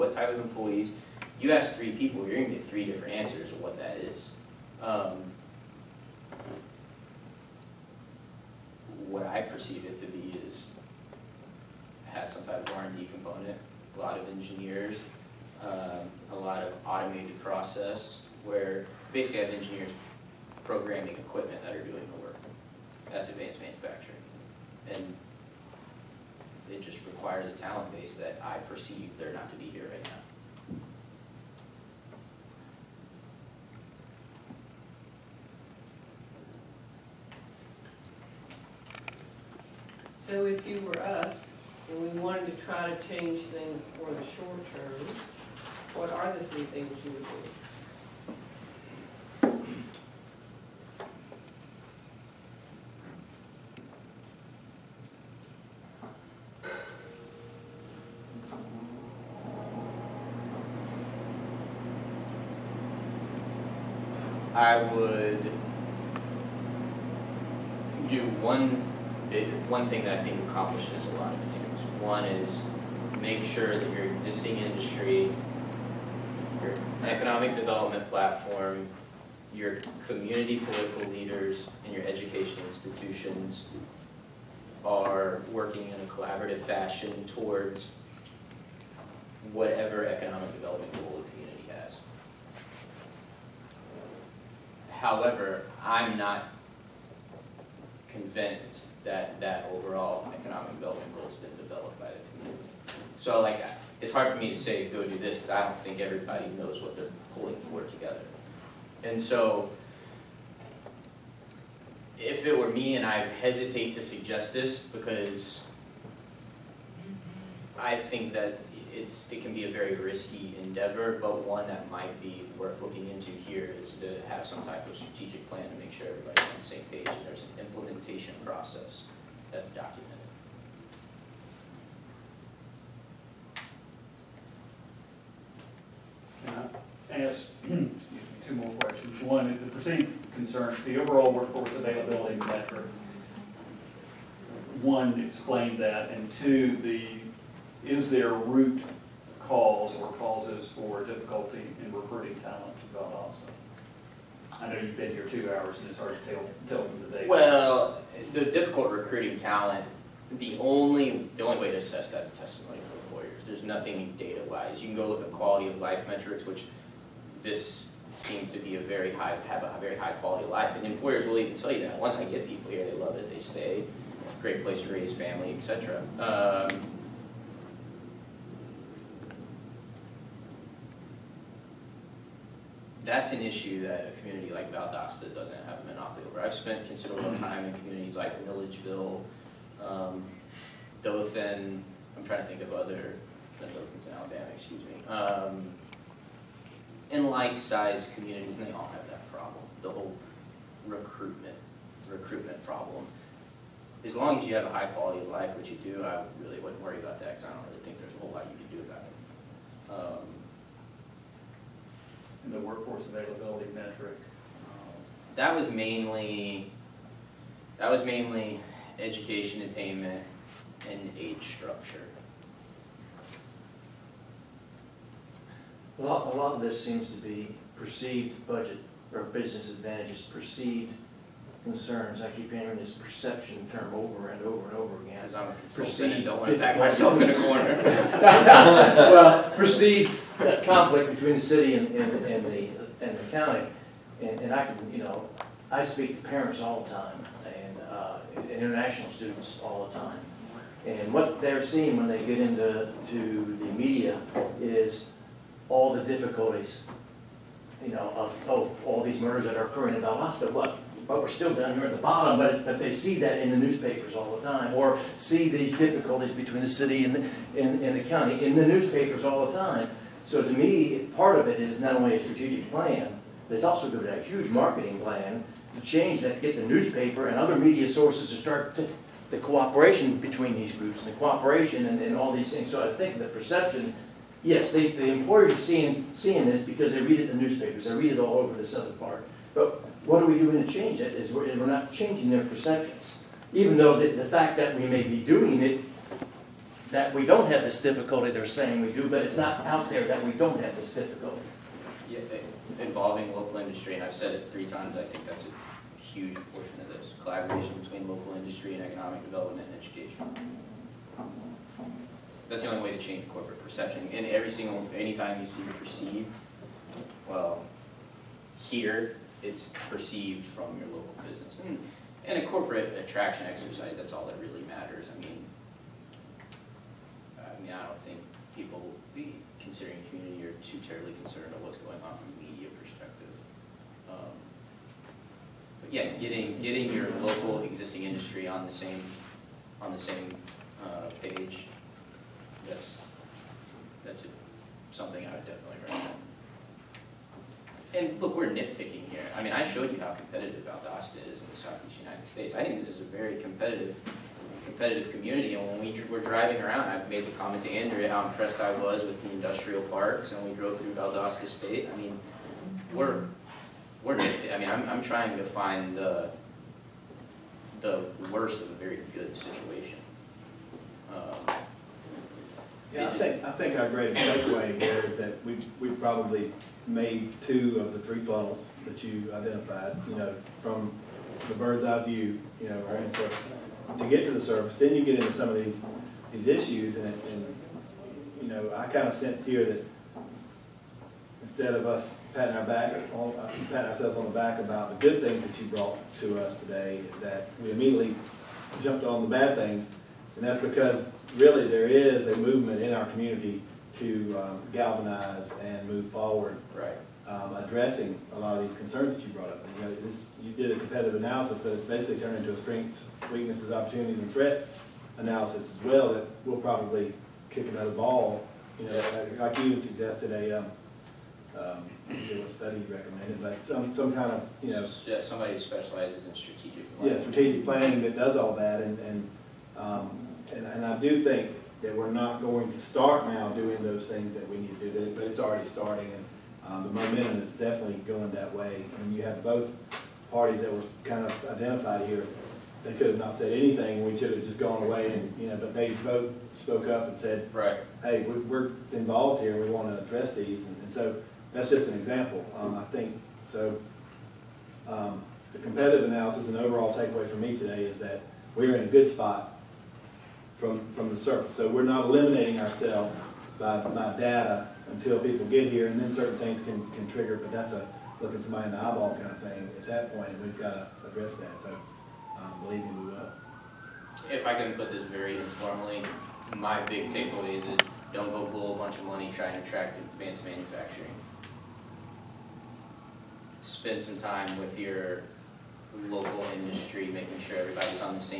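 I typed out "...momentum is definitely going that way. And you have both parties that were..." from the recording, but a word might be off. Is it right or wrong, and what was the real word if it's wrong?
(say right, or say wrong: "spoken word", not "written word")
right.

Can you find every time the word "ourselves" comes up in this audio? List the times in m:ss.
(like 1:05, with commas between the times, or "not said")
6:33, 7:42.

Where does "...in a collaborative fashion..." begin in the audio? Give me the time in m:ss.
1:25.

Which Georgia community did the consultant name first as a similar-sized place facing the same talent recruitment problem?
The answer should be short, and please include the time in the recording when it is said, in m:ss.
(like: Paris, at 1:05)
Milledgeville, at 3:08.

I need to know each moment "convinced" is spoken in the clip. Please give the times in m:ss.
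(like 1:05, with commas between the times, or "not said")
1:38.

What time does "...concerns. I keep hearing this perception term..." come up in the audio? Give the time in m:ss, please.
3:51.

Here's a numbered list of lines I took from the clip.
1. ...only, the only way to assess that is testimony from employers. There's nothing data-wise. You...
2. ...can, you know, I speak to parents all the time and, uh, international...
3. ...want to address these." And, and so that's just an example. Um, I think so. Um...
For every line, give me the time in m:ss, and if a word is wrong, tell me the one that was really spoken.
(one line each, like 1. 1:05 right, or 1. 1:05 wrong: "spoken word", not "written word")
1. 2:40 right
2. 4:04 right
3. 7:29 right.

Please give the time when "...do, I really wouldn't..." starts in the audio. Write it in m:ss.
3:25.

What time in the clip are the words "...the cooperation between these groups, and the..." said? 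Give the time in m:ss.
4:39.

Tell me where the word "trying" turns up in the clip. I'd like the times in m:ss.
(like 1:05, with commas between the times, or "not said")
3:12, 6:05, 7:59.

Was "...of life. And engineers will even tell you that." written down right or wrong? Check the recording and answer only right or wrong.
wrong.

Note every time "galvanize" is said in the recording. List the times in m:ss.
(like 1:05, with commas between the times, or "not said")
6:44.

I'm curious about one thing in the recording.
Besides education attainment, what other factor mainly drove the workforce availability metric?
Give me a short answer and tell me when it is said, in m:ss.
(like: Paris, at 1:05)
Age structure, at 3:41.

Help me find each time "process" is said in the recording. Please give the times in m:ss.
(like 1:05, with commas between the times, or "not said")
0:17, 2:08.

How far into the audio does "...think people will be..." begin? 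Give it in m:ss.
5:28.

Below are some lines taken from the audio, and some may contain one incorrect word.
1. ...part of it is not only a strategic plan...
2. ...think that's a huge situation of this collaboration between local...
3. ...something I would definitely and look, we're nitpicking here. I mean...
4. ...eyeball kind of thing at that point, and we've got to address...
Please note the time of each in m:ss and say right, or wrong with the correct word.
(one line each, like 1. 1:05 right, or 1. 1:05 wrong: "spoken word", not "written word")
1. 4:31 right
2. 5:05 wrong: "portion", not "situation"
3. 5:44 right
4. 7:48 right.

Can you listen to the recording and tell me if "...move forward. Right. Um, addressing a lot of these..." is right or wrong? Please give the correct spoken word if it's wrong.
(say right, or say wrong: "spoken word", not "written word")
right.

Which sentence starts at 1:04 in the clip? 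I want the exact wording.
I would one thing that I think accomplishes a lot of things.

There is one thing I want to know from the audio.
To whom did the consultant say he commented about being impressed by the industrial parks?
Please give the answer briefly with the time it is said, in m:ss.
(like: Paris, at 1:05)
Andrea, at 5:57.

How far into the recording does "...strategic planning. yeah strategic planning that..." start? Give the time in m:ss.
7:06.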